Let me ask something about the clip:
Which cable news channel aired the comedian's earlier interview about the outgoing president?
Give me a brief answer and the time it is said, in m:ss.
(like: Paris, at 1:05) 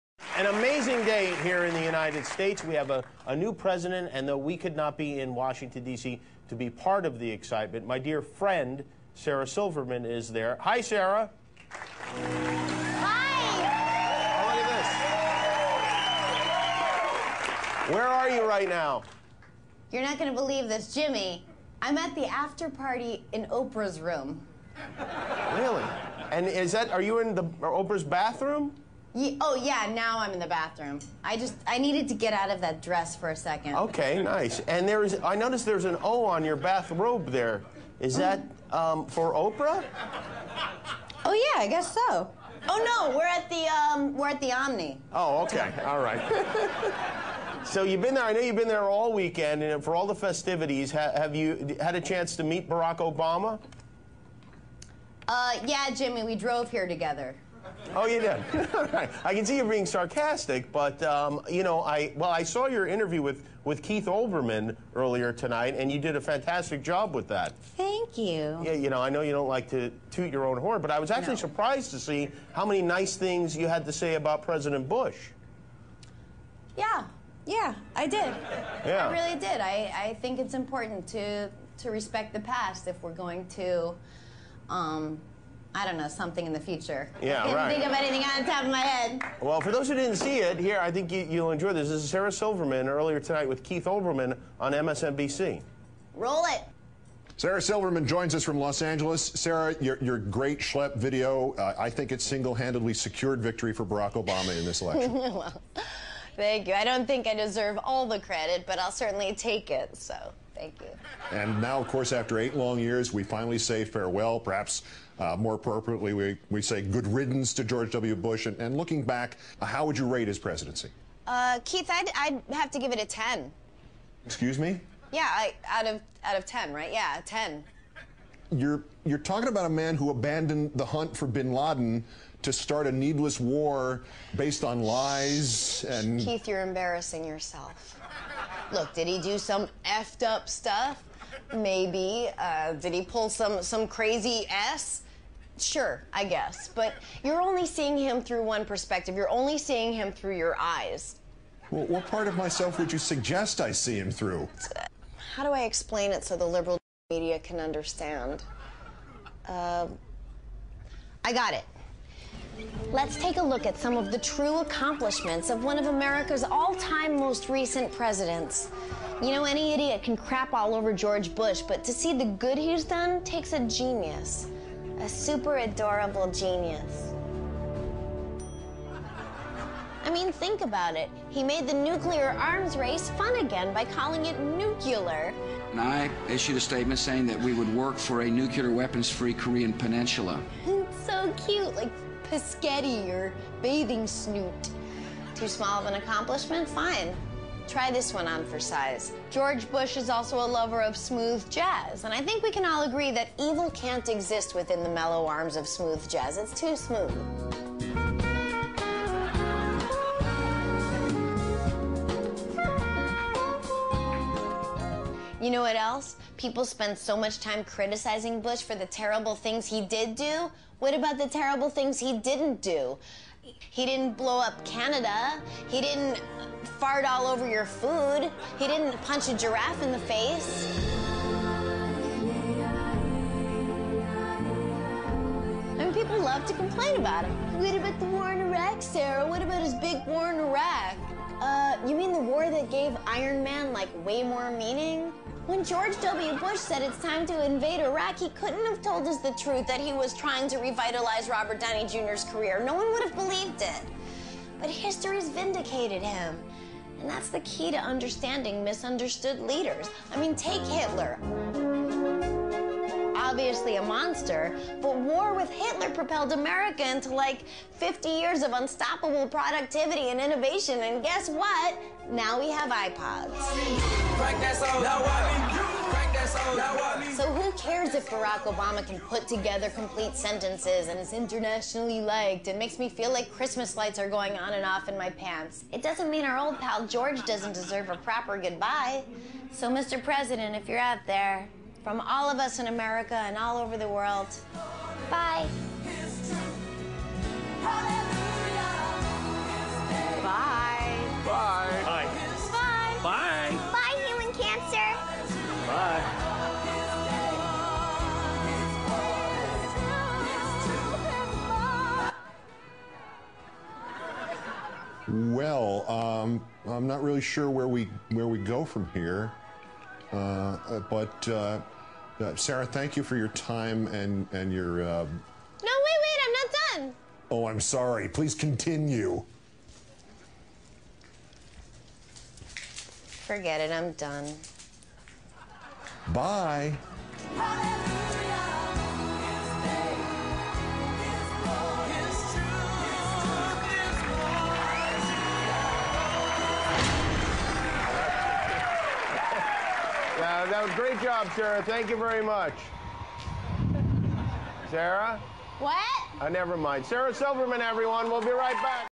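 MSNBC, at 1:34.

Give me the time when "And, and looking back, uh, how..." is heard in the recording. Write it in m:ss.
1:58.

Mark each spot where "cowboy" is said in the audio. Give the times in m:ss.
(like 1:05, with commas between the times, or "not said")
not said.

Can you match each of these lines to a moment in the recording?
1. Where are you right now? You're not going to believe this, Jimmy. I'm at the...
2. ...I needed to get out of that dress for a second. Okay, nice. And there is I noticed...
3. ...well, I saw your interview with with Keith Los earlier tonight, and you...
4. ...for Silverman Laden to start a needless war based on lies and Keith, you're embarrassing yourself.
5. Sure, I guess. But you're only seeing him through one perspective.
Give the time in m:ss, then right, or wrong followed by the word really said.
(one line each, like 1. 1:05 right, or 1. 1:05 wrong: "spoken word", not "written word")
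1. 0:17 right
2. 0:31 right
3. 1:02 wrong: "Olbermann", not "Los"
4. 2:11 wrong: "Bin", not "Silverman"
5. 2:25 right.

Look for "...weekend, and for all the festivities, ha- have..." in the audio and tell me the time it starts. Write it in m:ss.
0:49.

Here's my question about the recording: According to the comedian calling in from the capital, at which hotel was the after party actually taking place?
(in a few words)
Omni.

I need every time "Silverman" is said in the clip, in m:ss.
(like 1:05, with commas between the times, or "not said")
0:09, 1:32, 1:37, 5:57.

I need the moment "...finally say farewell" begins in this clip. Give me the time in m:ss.
1:53.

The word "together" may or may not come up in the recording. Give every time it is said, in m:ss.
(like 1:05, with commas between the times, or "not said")
0:56, 4:39.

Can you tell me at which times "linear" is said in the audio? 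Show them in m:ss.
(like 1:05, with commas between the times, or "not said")
not said.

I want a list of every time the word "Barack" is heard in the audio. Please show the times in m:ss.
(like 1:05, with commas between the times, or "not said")
0:52, 1:43, 4:38.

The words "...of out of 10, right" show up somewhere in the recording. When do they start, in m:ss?
2:05.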